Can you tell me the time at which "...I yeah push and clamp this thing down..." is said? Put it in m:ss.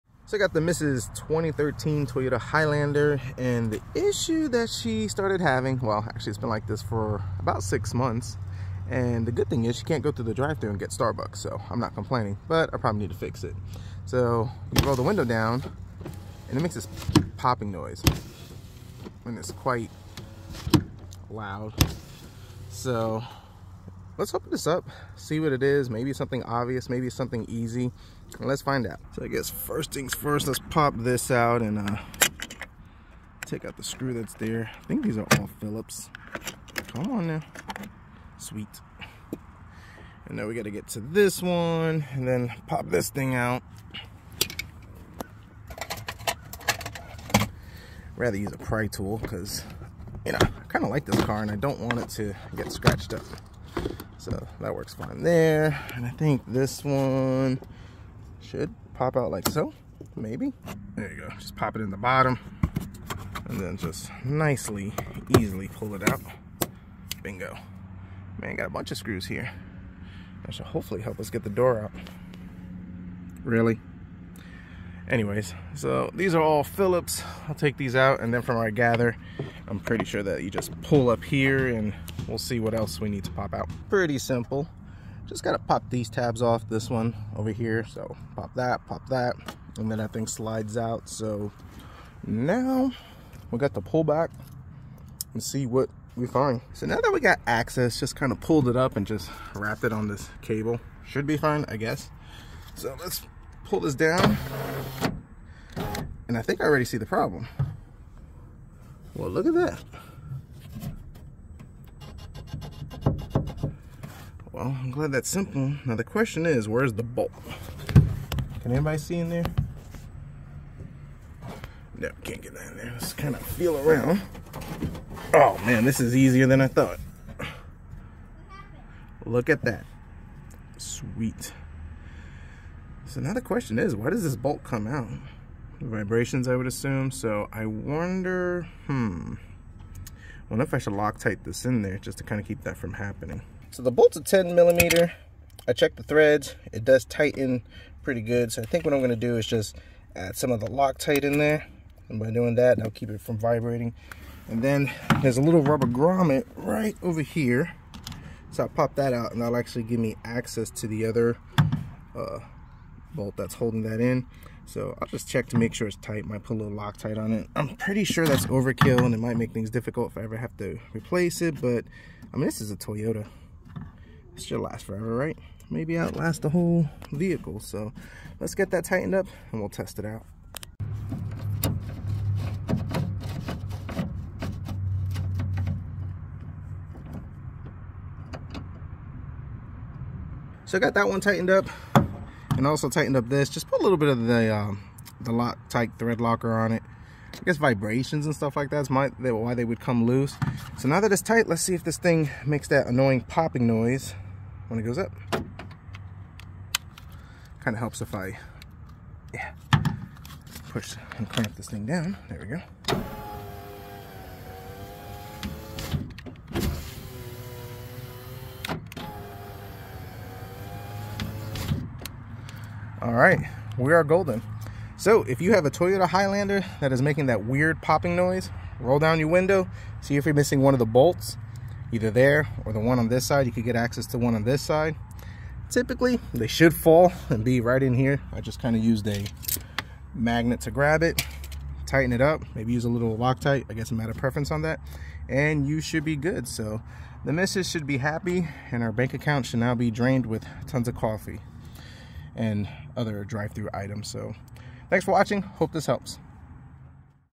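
3:28.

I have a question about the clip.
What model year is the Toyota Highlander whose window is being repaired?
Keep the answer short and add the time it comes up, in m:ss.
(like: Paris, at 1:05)
2013, at 0:01.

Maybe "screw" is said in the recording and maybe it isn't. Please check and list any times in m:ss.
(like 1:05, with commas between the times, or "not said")
0:33, 1:08.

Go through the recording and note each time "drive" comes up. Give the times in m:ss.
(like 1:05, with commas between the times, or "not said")
0:10, 4:13.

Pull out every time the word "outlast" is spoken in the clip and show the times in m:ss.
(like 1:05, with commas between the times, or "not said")
2:55.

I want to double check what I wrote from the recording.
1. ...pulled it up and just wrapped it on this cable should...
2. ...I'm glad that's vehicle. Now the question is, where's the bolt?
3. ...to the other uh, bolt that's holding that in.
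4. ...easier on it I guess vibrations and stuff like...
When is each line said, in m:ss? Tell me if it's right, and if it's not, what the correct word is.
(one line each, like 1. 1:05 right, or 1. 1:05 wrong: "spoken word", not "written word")
1. 1:38 right
2. 1:54 wrong: "simple", not "vehicle"
3. 2:40 right
4. 3:16 wrong: "locker", not "easier".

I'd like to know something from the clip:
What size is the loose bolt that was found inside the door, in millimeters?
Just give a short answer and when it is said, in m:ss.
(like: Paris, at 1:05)
10 millimeter, at 2:24.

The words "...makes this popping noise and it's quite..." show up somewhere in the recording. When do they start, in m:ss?
0:16.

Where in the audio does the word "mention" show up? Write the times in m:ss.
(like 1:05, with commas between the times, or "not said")
not said.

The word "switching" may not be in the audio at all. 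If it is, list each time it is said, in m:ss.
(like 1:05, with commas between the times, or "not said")
not said.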